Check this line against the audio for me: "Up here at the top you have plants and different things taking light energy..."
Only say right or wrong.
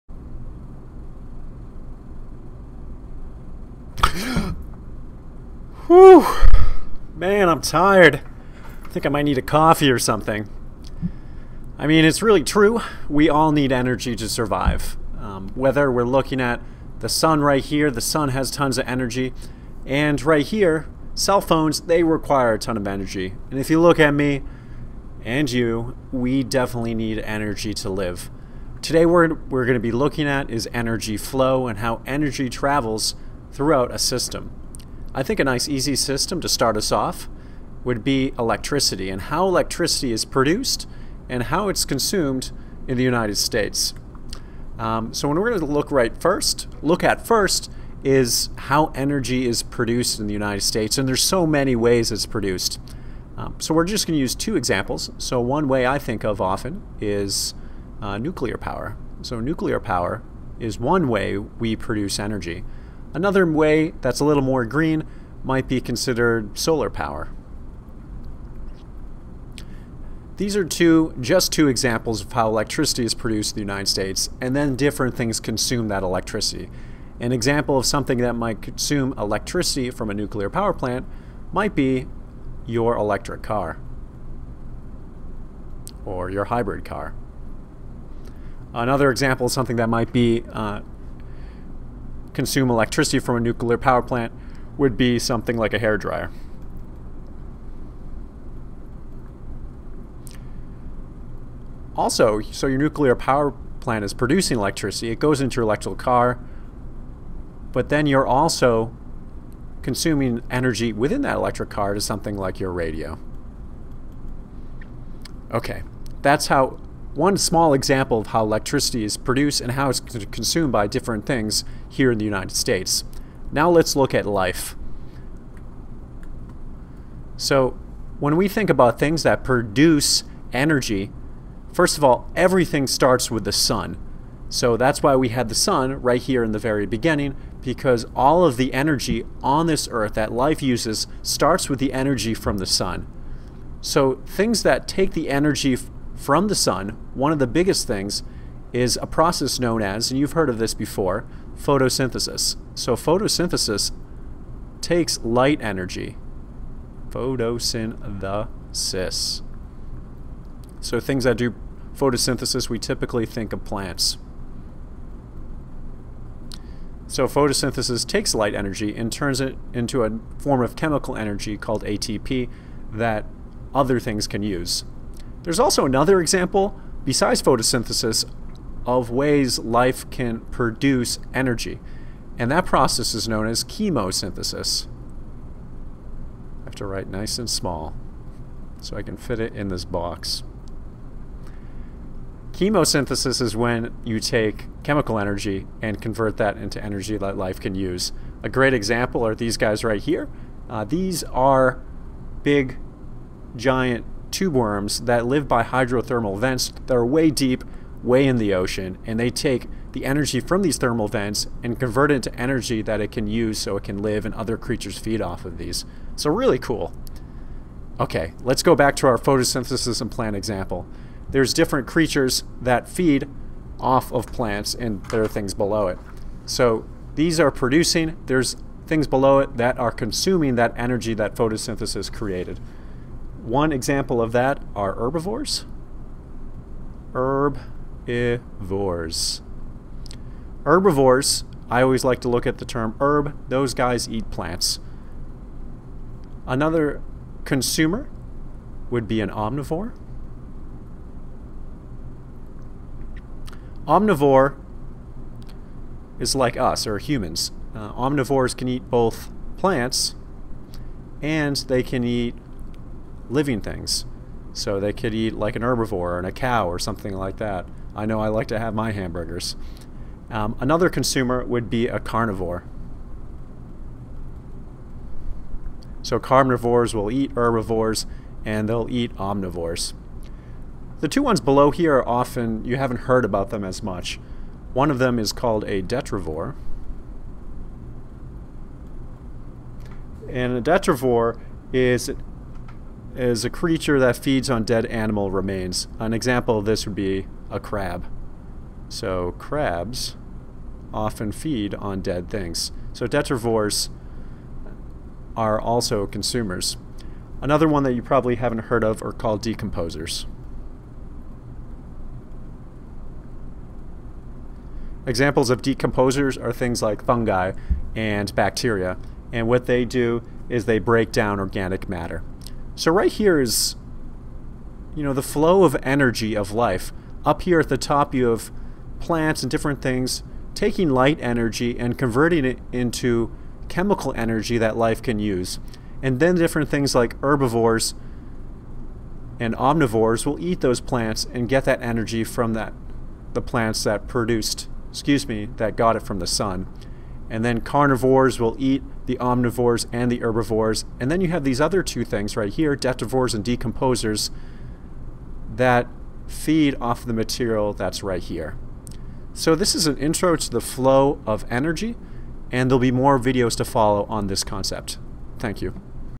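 right.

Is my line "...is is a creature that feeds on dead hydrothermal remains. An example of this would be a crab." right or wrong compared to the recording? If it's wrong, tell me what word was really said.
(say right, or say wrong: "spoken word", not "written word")
wrong: "animal", not "hydrothermal".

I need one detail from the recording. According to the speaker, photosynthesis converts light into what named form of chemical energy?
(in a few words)
ATP.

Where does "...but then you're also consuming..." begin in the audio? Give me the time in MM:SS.
01:47.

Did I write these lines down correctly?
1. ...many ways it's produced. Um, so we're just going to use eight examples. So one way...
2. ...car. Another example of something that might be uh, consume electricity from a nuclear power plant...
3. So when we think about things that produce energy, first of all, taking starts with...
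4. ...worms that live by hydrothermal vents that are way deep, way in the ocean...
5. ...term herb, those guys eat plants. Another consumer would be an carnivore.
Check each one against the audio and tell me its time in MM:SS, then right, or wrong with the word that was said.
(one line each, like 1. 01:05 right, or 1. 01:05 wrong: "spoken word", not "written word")
1. 00:51 wrong: "two", not "eight"
2. 01:26 right
3. 02:07 wrong: "everything", not "taking"
4. 03:24 right
5. 04:02 wrong: "omnivore", not "carnivore".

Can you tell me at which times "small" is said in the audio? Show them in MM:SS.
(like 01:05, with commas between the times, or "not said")
01:57, 03:07.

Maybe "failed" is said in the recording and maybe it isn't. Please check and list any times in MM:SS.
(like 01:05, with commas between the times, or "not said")
not said.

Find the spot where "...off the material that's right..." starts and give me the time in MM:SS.
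05:56.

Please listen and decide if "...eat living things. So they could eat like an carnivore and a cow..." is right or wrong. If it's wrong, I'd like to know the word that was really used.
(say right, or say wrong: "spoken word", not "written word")
wrong: "herbivore", not "carnivore".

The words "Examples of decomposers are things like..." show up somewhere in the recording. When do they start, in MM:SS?
05:15.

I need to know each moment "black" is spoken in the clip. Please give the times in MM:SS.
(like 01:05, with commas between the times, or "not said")
not said.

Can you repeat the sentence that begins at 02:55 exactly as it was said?
There's also another example, besides photosynthesis, of ways life can produce energy, and that process is known as chemosynthesis.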